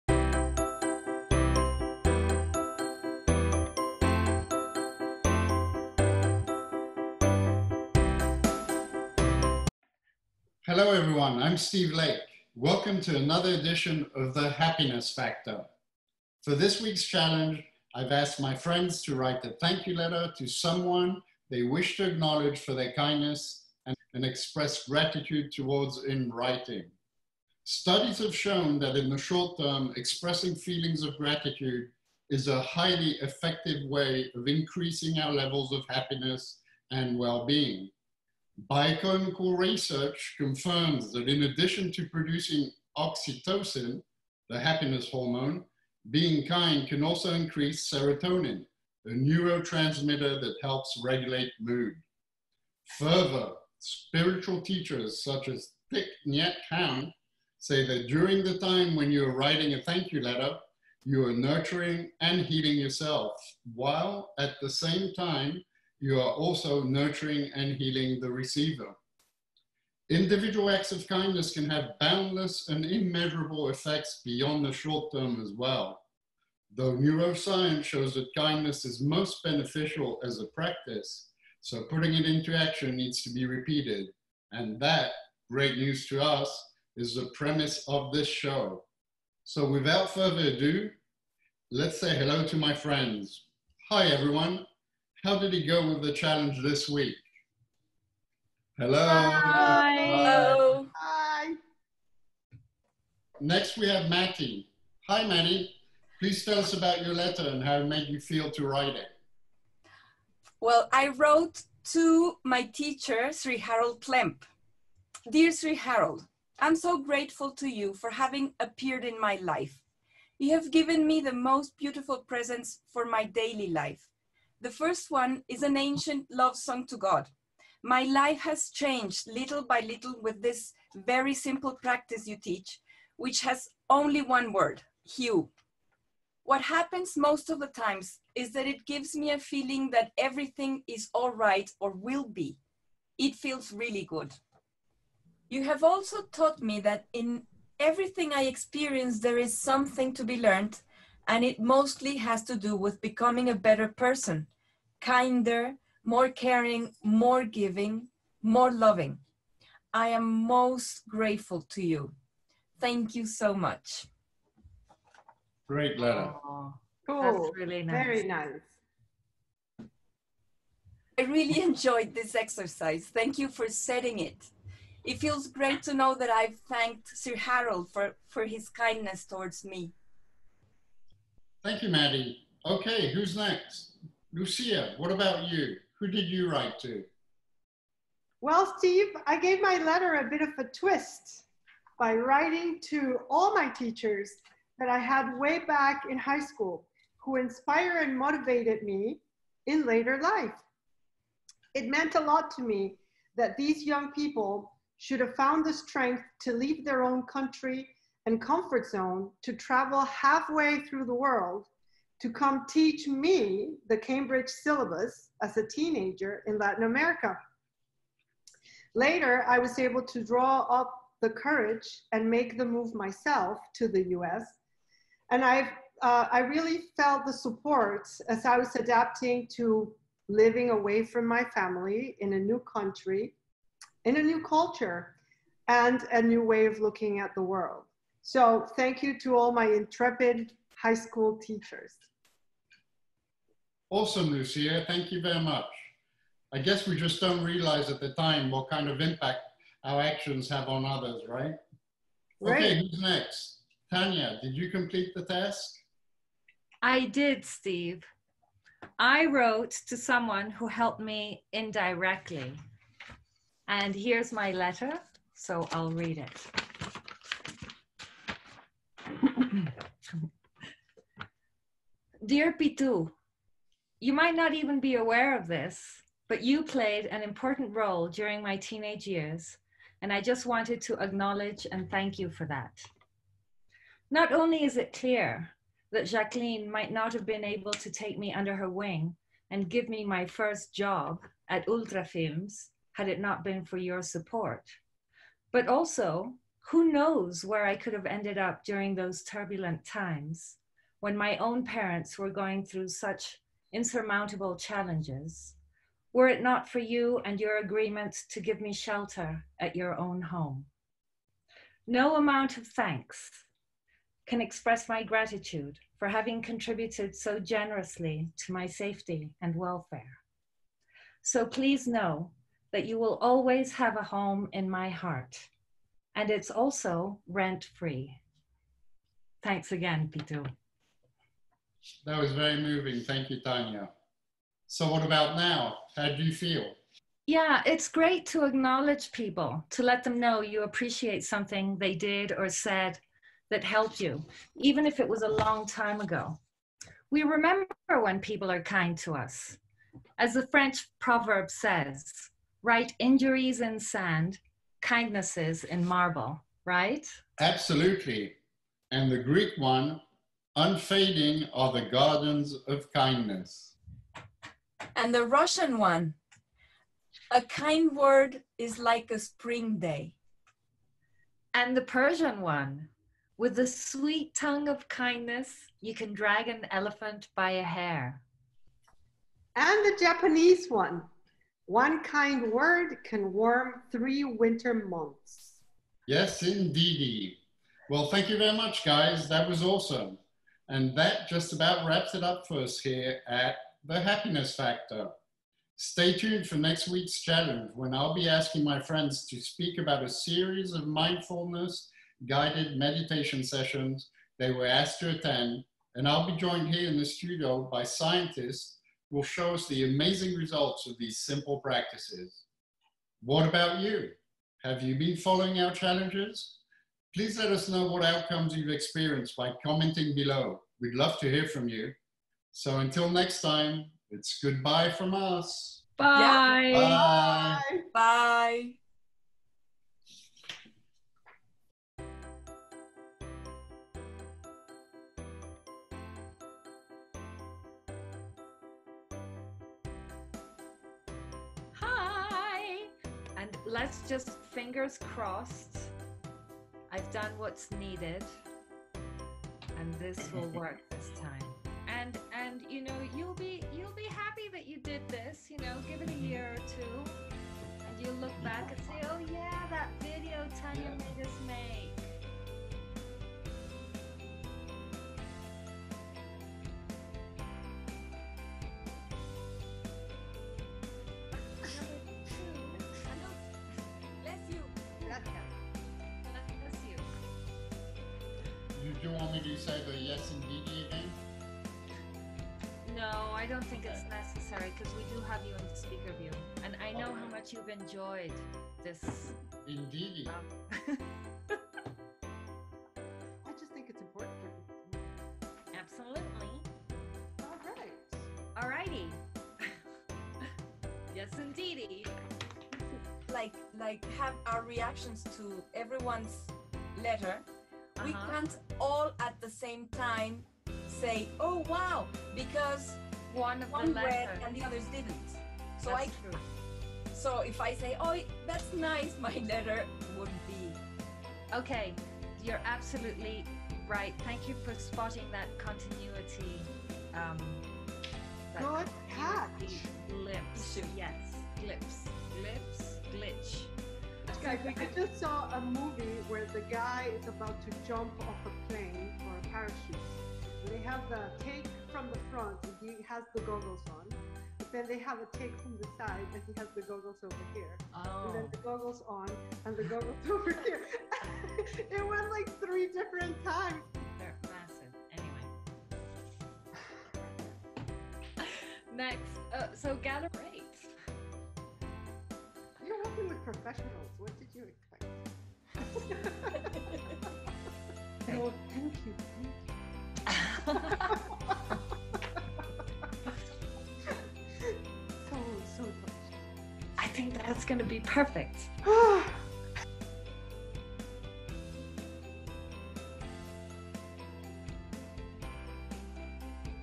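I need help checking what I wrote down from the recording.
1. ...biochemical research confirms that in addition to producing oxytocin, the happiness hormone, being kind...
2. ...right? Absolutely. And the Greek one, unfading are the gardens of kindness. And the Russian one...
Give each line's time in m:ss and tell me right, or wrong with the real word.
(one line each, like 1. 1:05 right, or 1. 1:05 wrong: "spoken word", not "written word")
1. 0:38 right
2. 5:56 right.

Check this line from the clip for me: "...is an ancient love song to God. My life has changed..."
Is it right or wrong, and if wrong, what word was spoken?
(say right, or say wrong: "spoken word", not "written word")
right.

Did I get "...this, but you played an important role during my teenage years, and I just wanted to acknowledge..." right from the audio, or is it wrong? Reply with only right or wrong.
right.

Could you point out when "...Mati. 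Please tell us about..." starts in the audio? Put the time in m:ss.
1:45.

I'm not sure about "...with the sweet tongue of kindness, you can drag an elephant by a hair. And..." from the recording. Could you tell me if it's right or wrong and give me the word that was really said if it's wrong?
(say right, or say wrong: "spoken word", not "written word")
right.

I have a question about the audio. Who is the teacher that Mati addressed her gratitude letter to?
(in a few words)
Sri Harold Klemp.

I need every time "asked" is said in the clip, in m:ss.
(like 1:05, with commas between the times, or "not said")
0:18, 6:44.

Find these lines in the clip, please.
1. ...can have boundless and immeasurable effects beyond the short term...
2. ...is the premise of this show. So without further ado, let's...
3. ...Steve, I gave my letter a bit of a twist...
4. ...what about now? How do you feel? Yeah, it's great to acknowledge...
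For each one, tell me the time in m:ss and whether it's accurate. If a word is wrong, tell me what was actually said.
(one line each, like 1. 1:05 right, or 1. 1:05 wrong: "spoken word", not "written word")
1. 1:11 right
2. 1:26 right
3. 3:08 right
4. 5:34 right.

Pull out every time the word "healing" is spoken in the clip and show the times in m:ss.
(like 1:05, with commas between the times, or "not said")
1:02, 1:07.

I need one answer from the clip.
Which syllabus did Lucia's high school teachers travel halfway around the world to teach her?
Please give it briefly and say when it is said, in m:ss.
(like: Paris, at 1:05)
the Cambridge syllabus, at 3:33.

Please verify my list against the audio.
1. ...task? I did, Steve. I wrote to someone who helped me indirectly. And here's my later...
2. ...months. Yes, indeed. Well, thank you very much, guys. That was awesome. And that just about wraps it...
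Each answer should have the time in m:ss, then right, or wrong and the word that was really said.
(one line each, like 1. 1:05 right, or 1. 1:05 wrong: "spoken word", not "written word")
1. 4:15 wrong: "letter", not "later"
2. 6:24 right.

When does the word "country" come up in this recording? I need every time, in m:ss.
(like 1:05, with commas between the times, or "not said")
3:27, 3:52.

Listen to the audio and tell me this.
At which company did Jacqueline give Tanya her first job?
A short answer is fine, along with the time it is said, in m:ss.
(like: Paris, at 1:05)
Ultra Films, at 4:51.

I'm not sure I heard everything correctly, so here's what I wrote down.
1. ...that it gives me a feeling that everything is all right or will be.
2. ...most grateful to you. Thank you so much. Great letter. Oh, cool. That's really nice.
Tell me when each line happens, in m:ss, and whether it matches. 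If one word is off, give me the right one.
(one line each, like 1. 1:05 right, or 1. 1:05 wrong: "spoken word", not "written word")
1. 2:18 right
2. 2:40 right.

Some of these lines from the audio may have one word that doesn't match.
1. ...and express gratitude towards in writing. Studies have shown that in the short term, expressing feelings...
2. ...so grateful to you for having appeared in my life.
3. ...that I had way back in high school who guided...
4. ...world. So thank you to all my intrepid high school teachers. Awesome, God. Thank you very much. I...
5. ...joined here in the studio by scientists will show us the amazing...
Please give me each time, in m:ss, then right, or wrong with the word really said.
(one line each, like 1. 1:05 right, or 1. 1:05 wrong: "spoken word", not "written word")
1. 0:24 right
2. 1:56 right
3. 3:14 wrong: "inspired", not "guided"
4. 3:57 wrong: "Lucia", not "God"
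5. 6:46 right.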